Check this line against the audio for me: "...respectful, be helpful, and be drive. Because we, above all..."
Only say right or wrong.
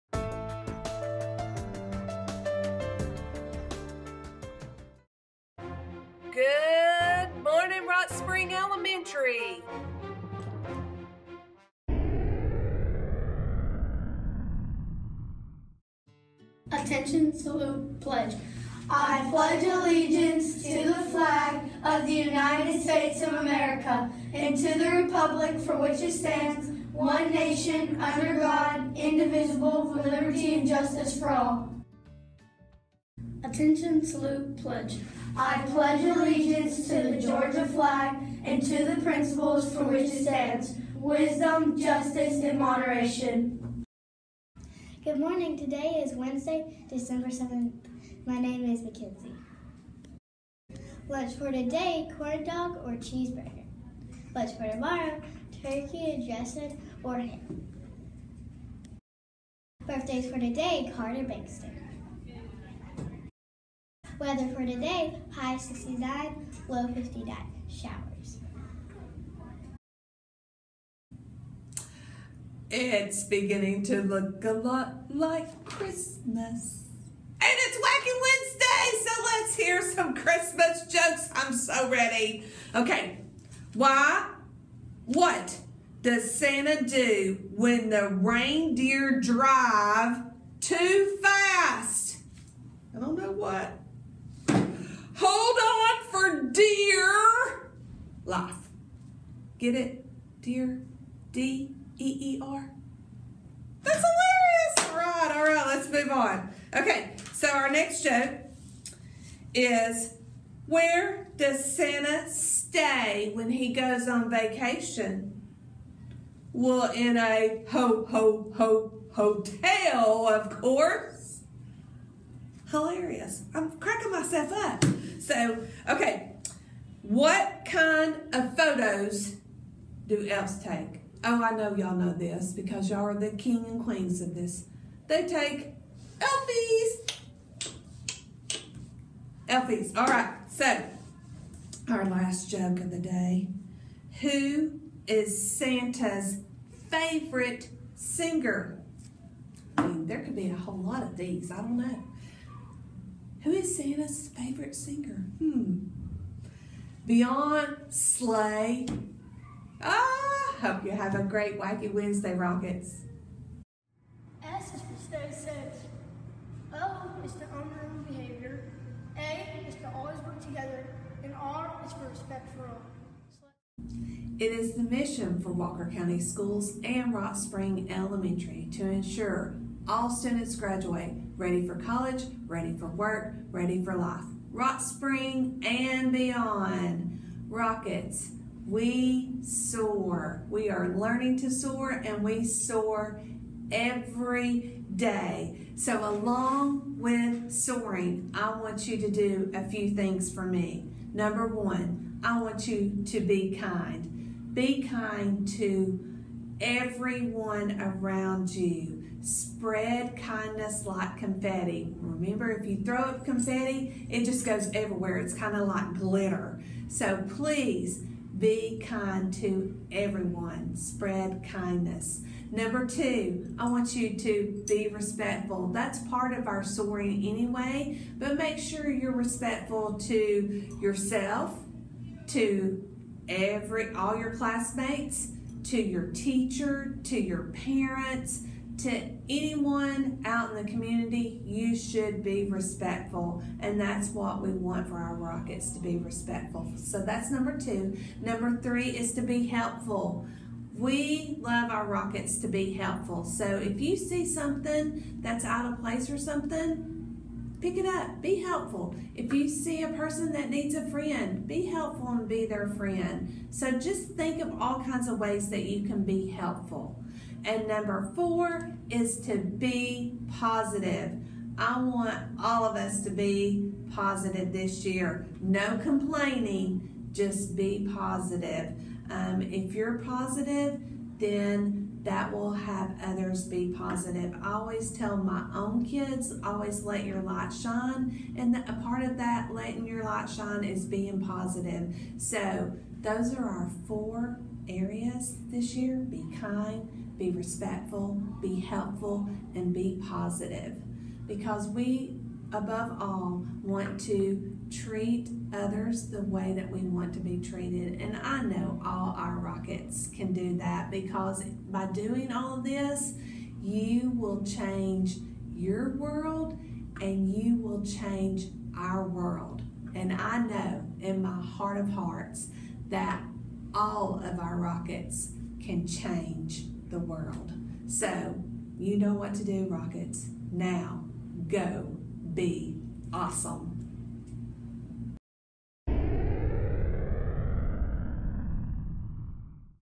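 wrong.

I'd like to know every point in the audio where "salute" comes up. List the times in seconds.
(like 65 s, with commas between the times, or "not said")
17 s, 34 s.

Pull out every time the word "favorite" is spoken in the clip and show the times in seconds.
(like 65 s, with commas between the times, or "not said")
146 s, 154 s.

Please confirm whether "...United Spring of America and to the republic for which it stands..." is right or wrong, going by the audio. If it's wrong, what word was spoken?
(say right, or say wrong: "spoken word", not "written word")
wrong: "States", not "Spring".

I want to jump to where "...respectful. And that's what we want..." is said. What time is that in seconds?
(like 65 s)
242 s.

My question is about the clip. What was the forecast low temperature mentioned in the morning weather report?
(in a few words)
59.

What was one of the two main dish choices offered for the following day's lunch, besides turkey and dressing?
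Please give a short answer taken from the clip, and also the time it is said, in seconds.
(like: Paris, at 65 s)
ham, at 57 s.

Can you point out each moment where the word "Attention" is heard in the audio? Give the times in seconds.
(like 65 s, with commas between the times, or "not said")
16 s, 33 s.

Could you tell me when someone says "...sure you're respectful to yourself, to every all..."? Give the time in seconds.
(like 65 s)
228 s.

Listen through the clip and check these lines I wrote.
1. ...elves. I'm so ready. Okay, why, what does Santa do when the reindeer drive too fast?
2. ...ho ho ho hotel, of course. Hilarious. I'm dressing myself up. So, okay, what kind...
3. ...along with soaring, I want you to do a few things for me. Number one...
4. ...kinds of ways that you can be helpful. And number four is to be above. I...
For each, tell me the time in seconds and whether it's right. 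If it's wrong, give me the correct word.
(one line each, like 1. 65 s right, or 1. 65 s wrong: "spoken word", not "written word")
1. 80 s wrong: "jokes", not "elves"
2. 117 s wrong: "cracking", not "dressing"
3. 196 s right
4. 264 s wrong: "positive", not "above".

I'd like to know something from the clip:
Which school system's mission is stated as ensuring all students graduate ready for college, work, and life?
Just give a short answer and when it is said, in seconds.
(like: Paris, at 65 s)
Walker County Schools, at 175 s.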